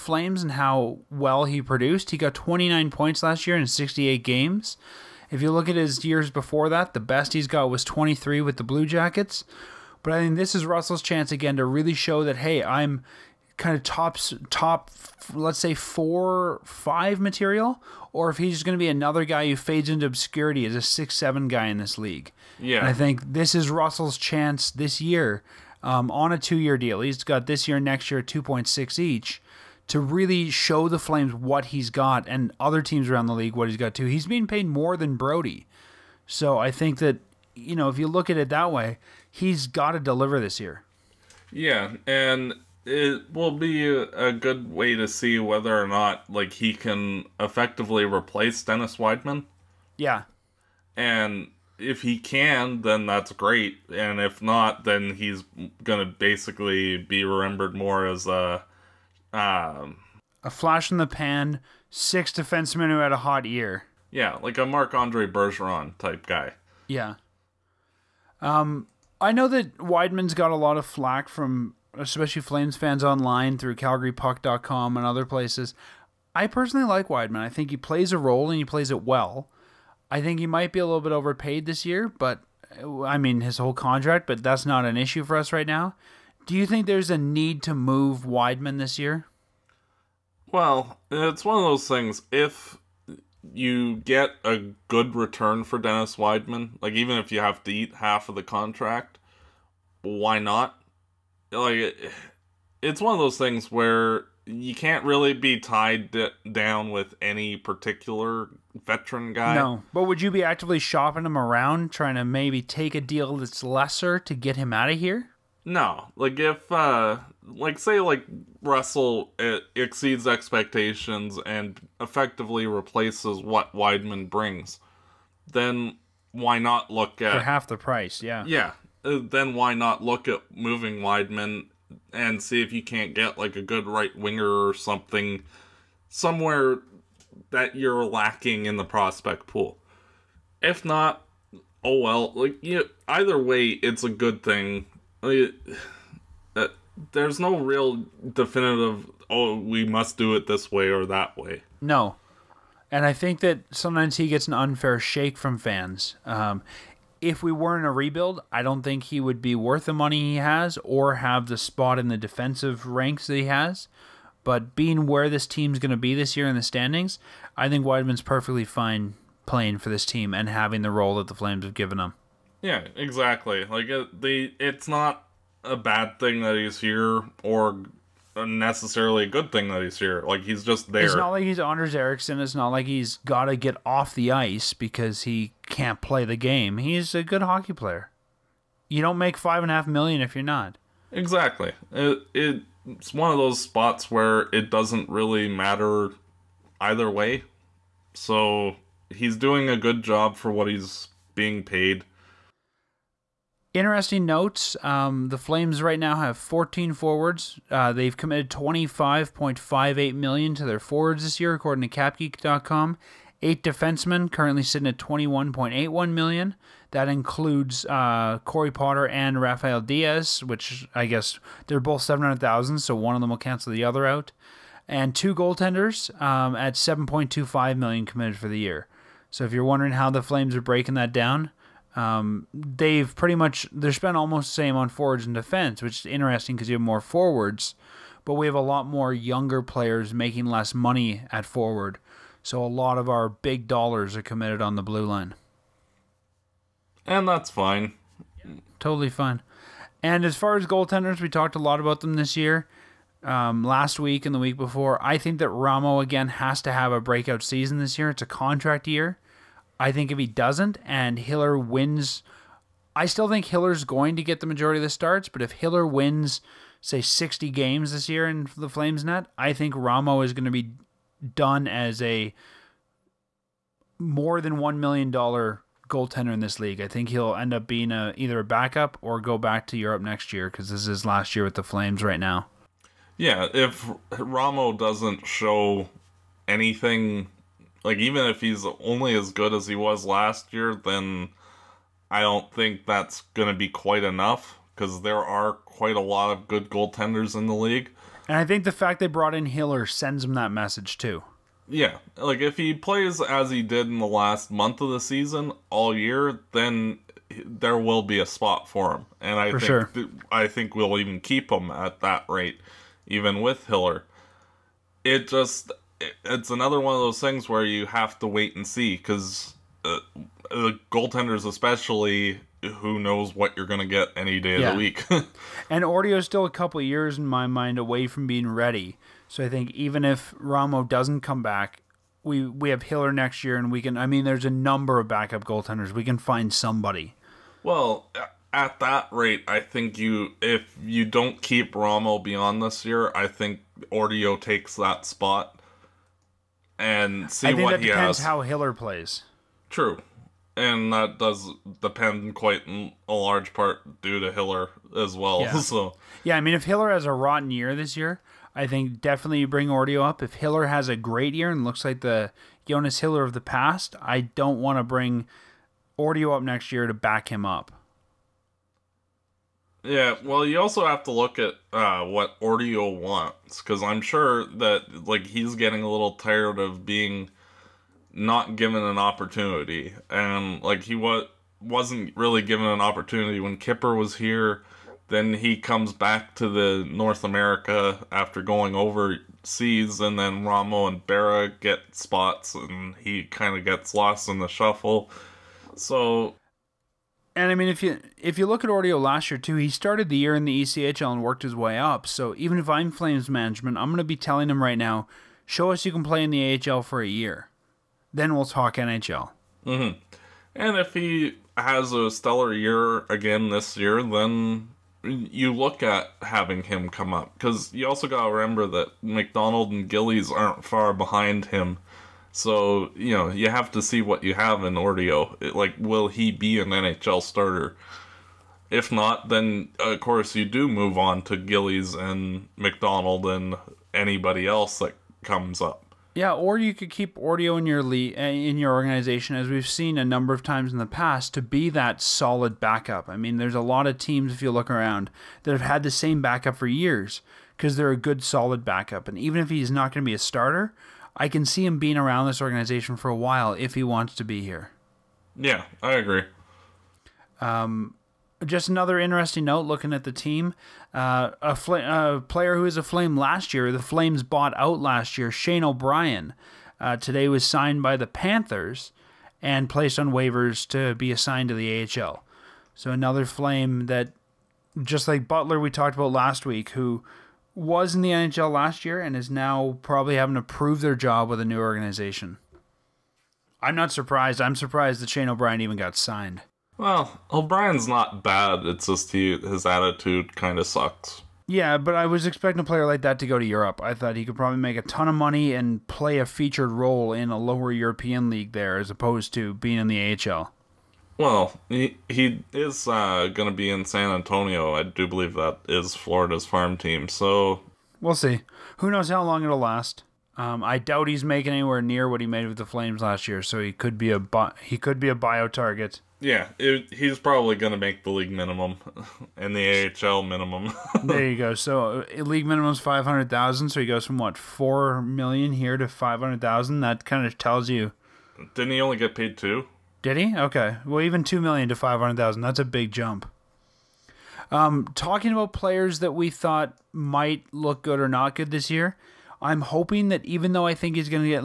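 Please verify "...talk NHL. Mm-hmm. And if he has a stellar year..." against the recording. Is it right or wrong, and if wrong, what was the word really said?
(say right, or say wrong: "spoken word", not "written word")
right.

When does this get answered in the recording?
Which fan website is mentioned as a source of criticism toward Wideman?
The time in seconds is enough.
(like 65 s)
73 s.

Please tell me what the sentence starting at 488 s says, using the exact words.
It's just he his attitude kind of sucks.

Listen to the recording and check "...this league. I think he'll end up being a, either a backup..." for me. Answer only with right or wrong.
right.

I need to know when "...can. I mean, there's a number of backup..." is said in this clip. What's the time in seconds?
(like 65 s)
333 s.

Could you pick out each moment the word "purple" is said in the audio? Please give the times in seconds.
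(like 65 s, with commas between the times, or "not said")
not said.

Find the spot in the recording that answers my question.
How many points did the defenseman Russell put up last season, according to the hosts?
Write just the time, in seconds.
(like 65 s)
2 s.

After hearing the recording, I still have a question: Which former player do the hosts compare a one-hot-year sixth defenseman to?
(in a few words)
Marc Andre Bergeron.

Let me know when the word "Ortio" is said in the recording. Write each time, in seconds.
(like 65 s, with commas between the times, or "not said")
343 s, 359 s, 365 s, 372 s, 398 s, 424 s, 437 s.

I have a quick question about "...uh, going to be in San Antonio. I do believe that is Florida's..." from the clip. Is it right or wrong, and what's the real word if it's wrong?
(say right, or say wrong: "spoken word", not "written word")
right.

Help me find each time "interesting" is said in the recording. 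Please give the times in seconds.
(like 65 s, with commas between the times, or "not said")
203 s, 236 s, 458 s.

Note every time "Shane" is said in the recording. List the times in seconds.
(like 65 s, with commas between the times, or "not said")
465 s, 485 s.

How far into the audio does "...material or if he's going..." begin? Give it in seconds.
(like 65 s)
17 s.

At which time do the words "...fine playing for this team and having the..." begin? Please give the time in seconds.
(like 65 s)
168 s.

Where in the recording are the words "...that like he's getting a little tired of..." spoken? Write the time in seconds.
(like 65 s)
374 s.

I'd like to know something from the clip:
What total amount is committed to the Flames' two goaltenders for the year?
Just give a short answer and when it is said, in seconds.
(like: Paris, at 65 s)
7.25 million, at 226 s.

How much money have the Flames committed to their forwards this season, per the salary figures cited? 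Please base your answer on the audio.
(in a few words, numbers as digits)
25.58 million.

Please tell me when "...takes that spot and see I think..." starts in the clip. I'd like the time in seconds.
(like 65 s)
344 s.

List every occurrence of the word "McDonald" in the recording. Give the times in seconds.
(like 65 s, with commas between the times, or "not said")
419 s, 432 s.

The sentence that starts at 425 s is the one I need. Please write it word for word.
It, like, will he be an NHL starter?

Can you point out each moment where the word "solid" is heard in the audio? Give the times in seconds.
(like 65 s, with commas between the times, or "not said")
442 s, 448 s.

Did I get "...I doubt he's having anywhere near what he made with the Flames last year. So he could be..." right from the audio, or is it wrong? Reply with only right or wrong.
wrong.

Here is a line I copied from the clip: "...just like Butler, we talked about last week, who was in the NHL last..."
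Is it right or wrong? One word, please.
right.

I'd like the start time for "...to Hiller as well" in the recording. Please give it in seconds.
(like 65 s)
354 s.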